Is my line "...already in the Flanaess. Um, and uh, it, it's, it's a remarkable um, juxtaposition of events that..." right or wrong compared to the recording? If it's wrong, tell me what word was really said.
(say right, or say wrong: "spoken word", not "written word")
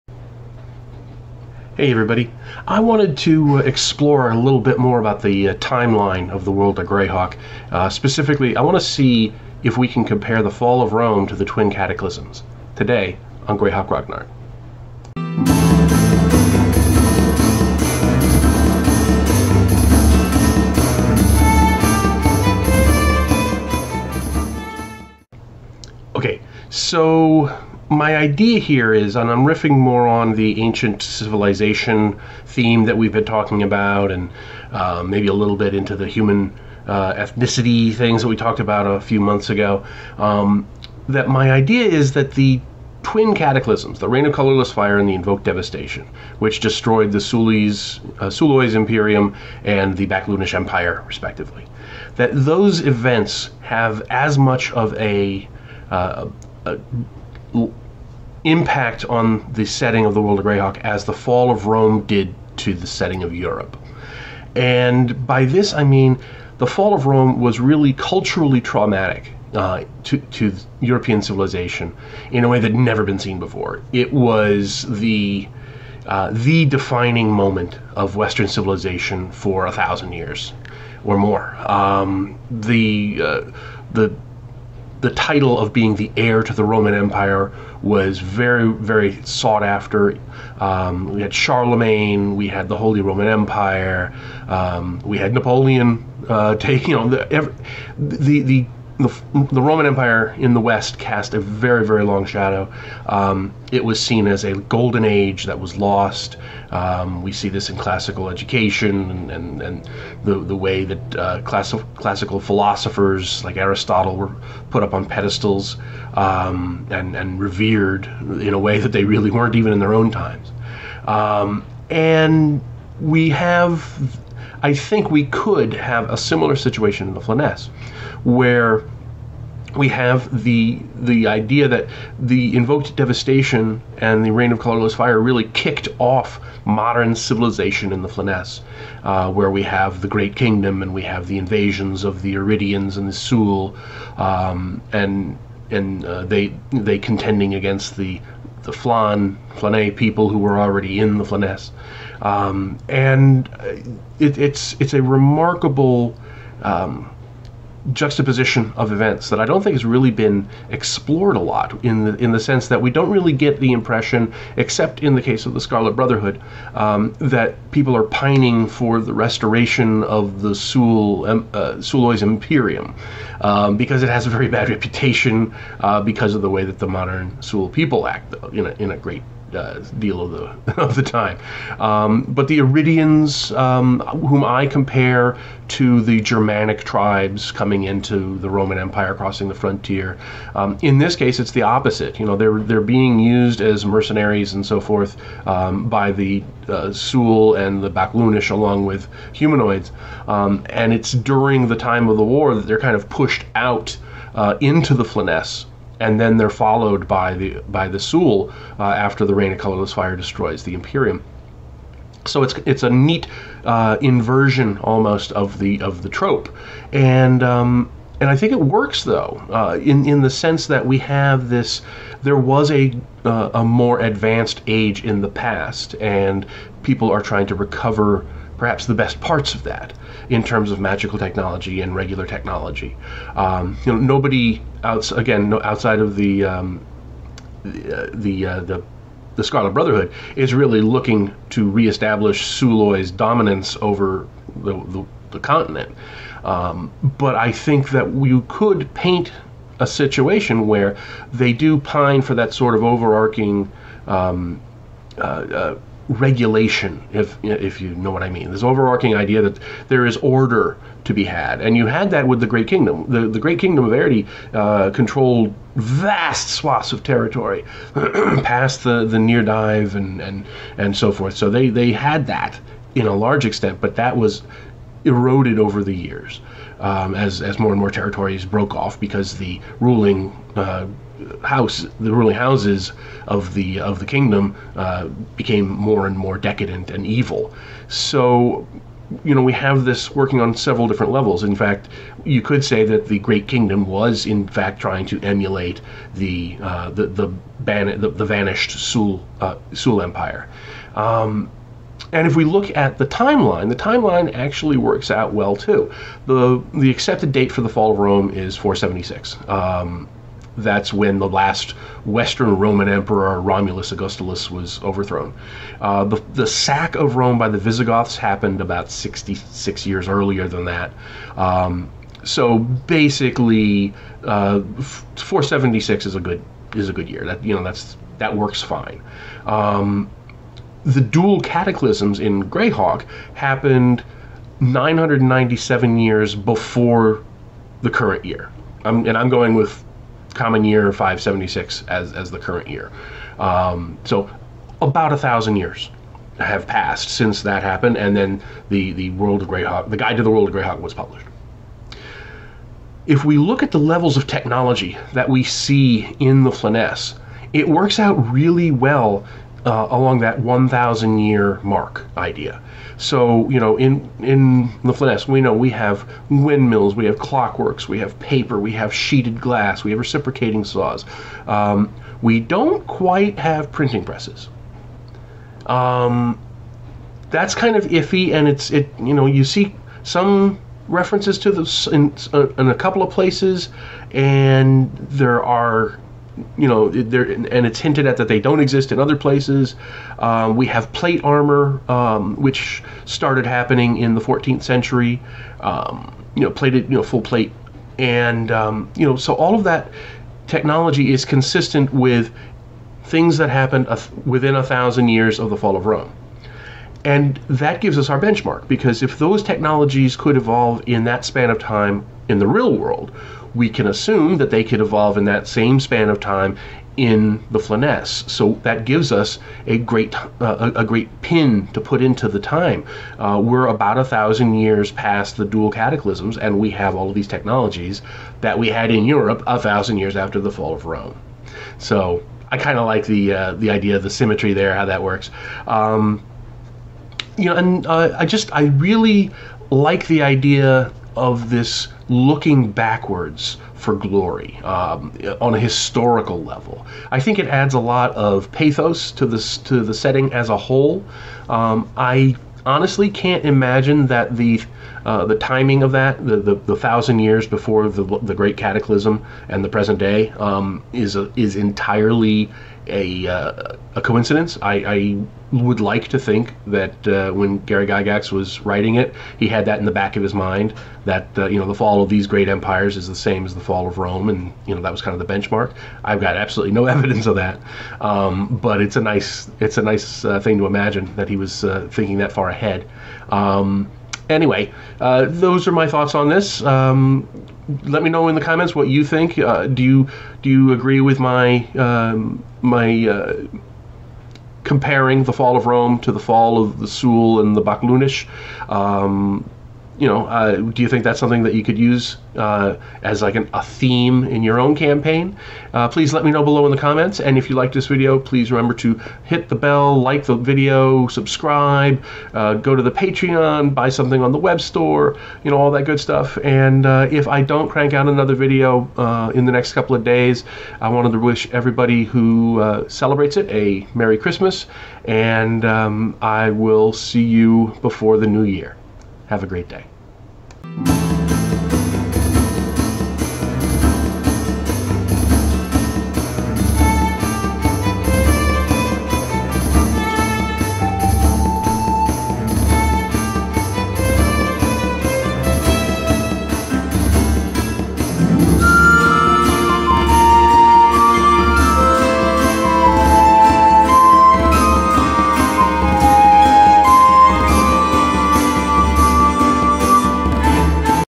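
right.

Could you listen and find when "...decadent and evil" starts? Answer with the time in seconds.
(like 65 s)
286 s.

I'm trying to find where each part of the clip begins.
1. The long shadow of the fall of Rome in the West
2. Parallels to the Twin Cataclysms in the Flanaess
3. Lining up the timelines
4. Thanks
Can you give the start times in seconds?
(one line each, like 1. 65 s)
1. 25 s
2. 125 s
3. 305 s
4. 530 s.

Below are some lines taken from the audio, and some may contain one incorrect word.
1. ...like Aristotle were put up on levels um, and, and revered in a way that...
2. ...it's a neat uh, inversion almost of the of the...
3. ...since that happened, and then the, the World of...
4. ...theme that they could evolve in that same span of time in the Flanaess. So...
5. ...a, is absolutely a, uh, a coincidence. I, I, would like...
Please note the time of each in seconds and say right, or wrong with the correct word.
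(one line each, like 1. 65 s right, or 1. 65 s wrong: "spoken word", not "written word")
1. 113 s wrong: "pedestals", not "levels"
2. 212 s right
3. 347 s right
4. 413 s wrong: "assume", not "theme"
5. 461 s wrong: "entirely", not "absolutely".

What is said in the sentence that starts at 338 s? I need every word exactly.
I'm, and I'm going with common year 576 as, as the current year.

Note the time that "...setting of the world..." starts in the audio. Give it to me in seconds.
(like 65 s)
59 s.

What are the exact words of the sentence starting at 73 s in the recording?
It was the uh, the defining moment of Western civilization for a thousand years or more.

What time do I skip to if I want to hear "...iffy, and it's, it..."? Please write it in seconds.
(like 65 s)
377 s.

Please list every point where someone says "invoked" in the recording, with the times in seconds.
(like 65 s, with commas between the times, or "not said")
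45 s, 132 s.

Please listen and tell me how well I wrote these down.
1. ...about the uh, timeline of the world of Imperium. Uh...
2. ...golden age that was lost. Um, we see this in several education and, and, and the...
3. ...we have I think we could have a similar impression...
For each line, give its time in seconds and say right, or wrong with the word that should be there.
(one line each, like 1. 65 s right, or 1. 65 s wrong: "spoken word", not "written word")
1. 4 s wrong: "Greyhawk", not "Imperium"
2. 104 s wrong: "classical", not "several"
3. 122 s wrong: "situation", not "impression".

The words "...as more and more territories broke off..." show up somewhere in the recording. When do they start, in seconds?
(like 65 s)
277 s.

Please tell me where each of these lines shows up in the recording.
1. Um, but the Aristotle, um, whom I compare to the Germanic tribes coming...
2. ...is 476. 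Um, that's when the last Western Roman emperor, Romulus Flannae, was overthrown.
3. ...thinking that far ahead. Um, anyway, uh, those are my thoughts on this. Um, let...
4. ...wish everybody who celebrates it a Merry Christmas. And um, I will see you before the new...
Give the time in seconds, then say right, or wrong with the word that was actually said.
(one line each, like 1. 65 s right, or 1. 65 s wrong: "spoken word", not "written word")
1. 181 s wrong: "Oeridians", not "Aristotle"
2. 308 s wrong: "Augustulus", not "Flannae"
3. 481 s right
4. 521 s right.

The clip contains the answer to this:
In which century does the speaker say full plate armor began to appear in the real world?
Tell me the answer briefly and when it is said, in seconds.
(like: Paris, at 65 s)
14th century, at 394 s.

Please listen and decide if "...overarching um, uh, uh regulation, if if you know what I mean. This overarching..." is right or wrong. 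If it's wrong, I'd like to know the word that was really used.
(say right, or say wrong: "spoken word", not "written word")
right.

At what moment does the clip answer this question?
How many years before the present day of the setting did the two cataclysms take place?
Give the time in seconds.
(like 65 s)
334 s.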